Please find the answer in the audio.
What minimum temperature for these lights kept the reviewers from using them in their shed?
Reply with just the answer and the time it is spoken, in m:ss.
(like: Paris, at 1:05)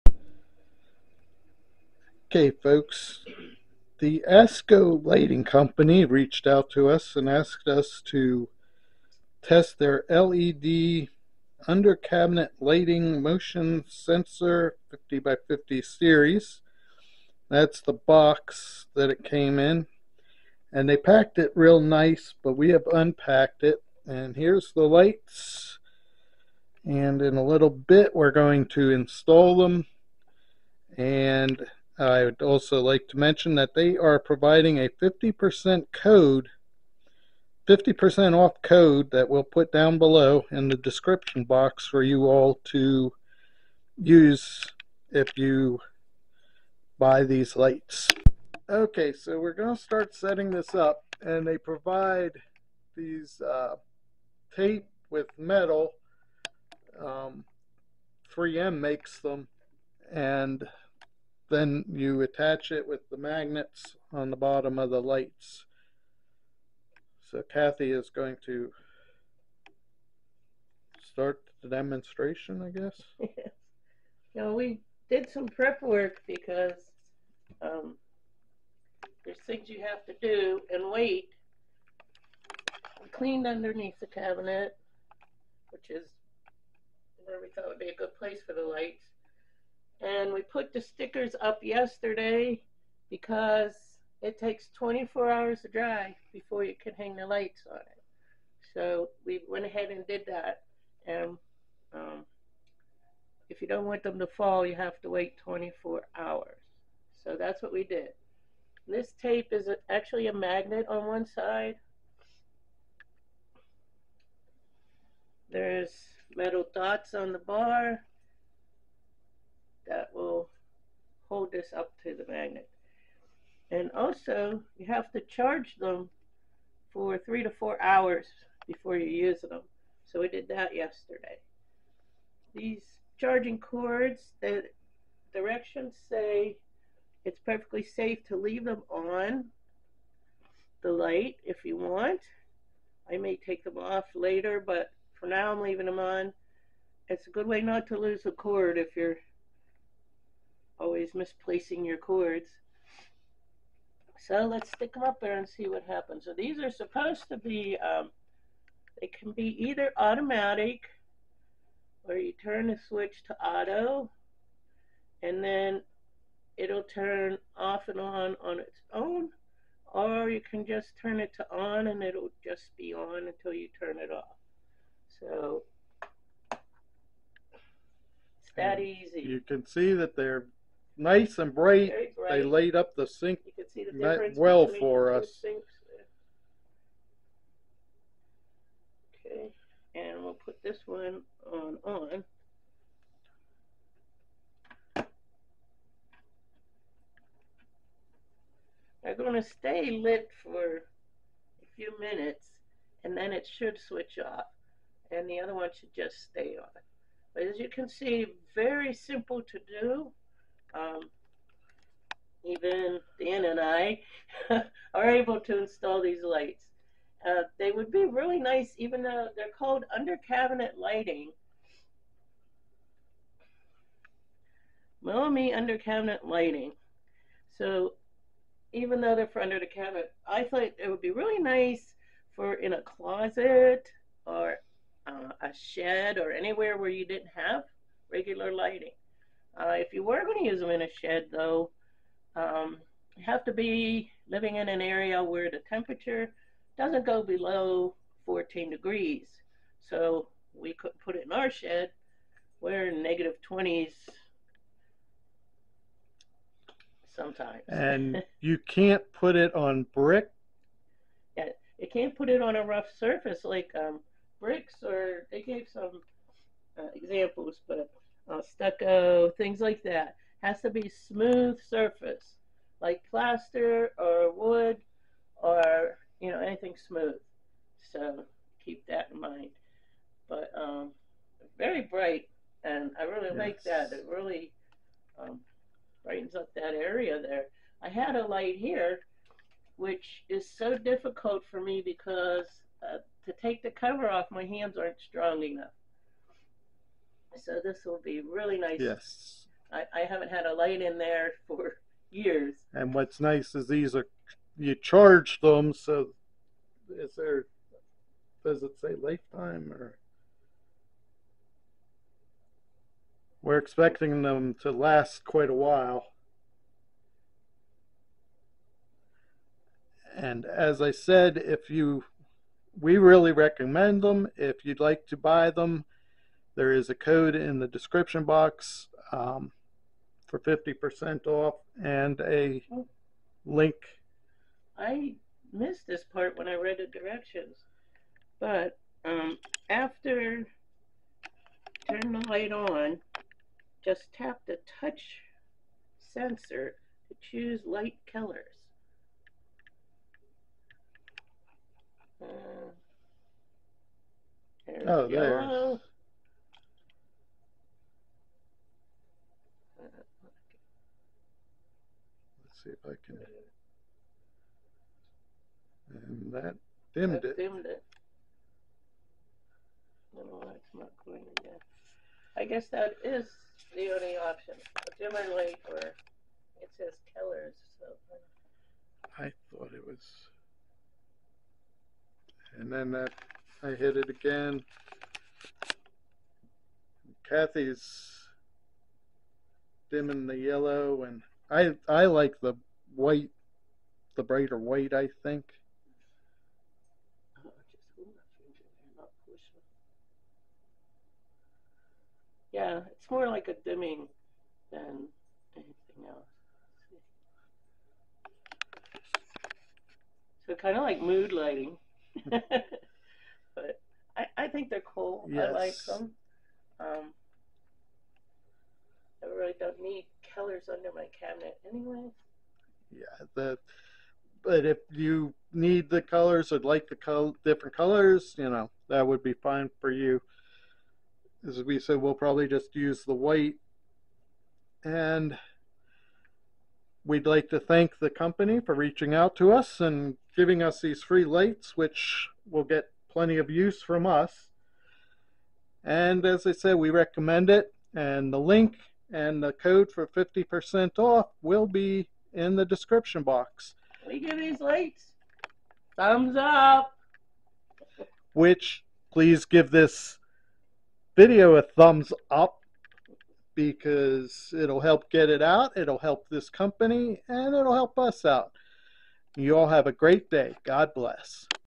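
14 degrees, at 4:08.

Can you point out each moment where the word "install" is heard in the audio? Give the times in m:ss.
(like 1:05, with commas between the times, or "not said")
0:28, 3:35.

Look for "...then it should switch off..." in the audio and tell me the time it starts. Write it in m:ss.
3:23.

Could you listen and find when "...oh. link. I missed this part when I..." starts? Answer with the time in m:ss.
5:32.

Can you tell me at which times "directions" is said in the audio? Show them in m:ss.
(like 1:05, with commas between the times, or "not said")
2:15, 5:36.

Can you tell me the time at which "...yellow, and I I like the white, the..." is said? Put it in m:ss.
6:30.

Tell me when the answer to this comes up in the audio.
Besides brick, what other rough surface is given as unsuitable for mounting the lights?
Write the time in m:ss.
4:28.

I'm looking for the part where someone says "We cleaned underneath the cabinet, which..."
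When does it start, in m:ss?
1:23.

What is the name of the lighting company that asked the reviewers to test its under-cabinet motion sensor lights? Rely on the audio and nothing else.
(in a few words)
Tasko Lighting Company.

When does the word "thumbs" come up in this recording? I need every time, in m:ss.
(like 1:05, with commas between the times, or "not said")
7:35, 7:41.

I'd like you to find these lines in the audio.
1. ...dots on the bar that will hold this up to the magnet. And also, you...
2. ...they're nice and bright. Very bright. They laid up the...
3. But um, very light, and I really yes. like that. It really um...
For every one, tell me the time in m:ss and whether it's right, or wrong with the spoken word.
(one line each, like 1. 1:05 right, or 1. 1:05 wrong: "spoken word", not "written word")
1. 1:56 right
2. 3:00 right
3. 4:40 wrong: "bright", not "light".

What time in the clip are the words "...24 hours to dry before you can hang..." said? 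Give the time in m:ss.
1:34.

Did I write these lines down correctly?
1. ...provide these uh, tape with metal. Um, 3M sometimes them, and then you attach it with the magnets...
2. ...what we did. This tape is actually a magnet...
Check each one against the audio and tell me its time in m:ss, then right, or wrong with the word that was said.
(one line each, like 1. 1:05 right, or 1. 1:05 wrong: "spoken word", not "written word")
1. 0:51 wrong: "makes", not "sometimes"
2. 1:47 right.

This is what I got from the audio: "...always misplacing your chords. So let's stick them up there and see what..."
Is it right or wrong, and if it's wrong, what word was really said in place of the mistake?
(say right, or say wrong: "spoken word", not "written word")
right.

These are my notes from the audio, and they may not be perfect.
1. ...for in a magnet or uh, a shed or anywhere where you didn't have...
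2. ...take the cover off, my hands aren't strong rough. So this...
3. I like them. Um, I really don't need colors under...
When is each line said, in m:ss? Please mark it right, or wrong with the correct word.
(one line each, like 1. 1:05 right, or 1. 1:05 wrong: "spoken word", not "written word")
1. 3:52 wrong: "closet", not "magnet"
2. 4:53 wrong: "enough", not "rough"
3. 6:55 right.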